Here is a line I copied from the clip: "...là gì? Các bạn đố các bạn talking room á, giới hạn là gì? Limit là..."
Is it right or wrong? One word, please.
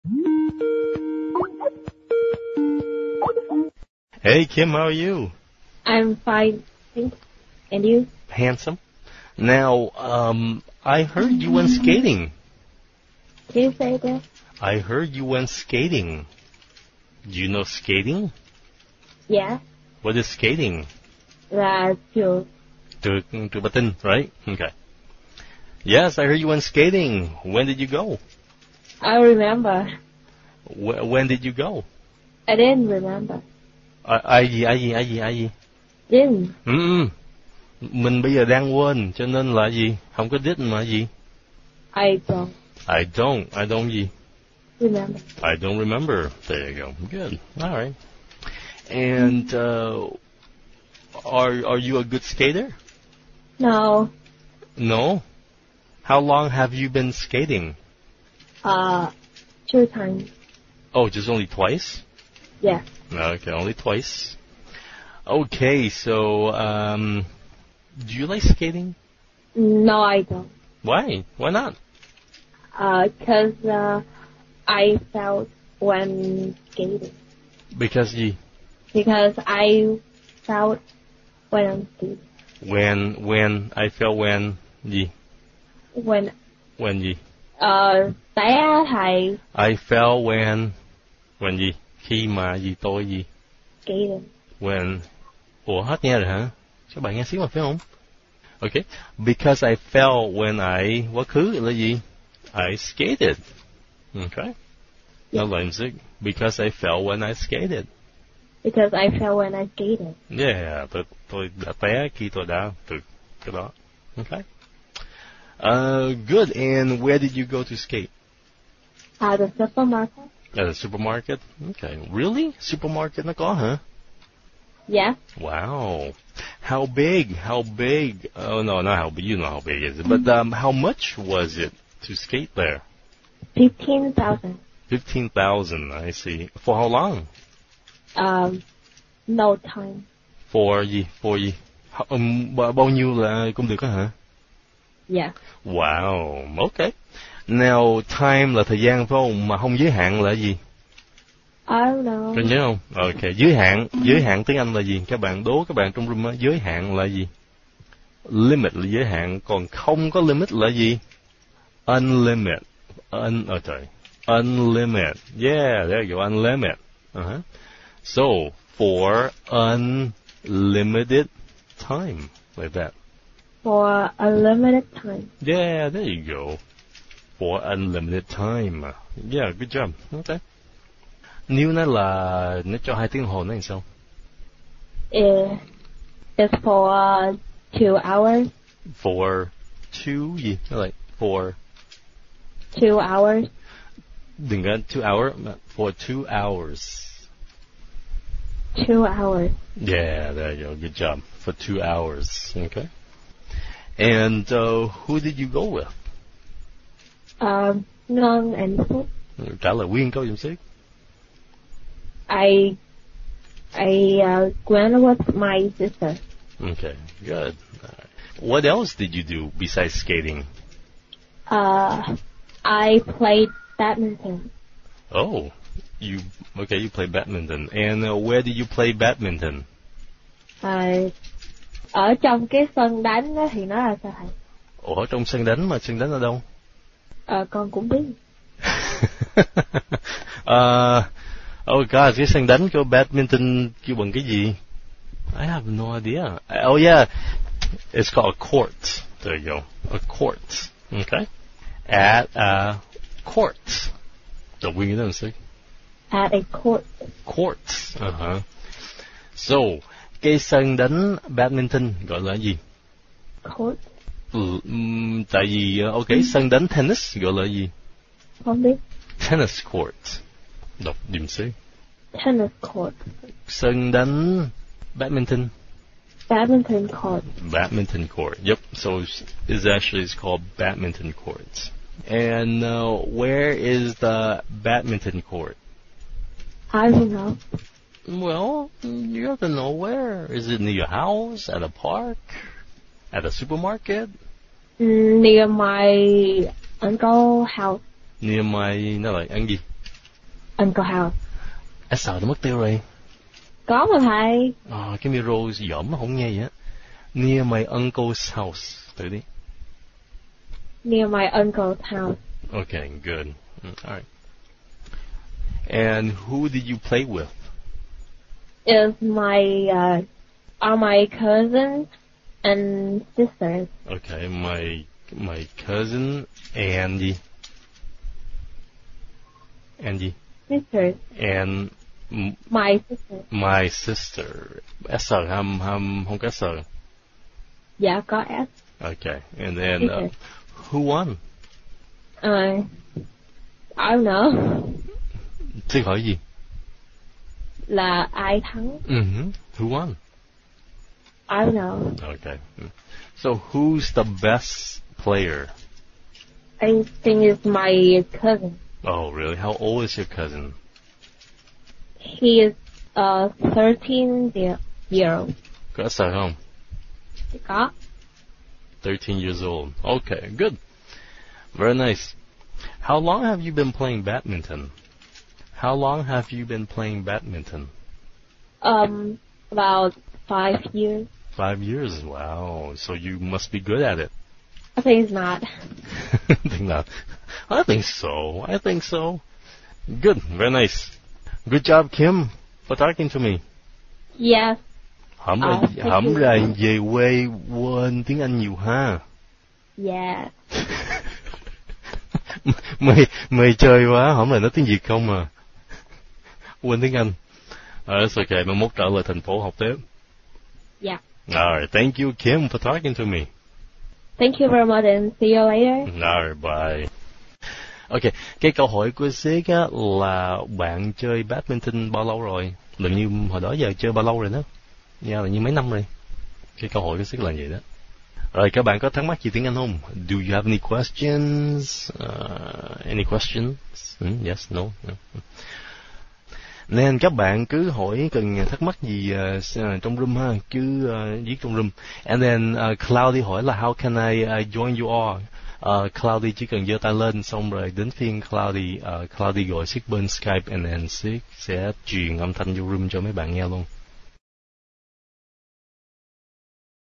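wrong.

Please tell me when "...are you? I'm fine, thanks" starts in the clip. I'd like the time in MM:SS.
00:04.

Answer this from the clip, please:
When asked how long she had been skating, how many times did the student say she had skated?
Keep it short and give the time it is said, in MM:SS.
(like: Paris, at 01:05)
2 times, at 00:59.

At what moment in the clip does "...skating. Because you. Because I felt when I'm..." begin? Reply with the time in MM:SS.
01:16.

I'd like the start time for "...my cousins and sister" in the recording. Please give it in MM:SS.
05:20.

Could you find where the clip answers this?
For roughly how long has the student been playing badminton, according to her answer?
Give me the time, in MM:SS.
06:19.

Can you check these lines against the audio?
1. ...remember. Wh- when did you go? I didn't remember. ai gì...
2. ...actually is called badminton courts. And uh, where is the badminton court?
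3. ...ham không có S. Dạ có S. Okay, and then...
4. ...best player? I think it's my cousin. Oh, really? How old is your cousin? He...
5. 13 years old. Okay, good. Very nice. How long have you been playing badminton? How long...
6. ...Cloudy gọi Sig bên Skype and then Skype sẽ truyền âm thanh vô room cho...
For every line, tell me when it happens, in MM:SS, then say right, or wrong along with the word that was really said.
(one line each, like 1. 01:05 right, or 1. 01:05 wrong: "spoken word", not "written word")
1. 00:29 right
2. 04:39 right
3. 05:35 right
4. 05:54 right
5. 06:08 right
6. 07:29 wrong: "Sig", not "Skype".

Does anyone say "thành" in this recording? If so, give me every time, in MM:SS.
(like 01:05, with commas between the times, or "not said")
06:49.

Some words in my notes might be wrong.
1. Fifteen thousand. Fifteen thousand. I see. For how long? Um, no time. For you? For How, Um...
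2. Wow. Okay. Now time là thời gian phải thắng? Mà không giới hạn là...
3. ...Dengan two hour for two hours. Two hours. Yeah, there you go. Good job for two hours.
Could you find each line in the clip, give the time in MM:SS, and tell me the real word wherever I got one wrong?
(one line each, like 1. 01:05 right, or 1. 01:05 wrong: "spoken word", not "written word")
1. 02:13 right
2. 02:25 wrong: "không", not "thắng"
3. 03:14 right.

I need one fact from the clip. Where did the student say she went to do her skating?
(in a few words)
the supermarket.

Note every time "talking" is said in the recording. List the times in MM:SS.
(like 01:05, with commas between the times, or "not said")
06:32, 06:52.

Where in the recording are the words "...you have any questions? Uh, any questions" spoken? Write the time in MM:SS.
07:10.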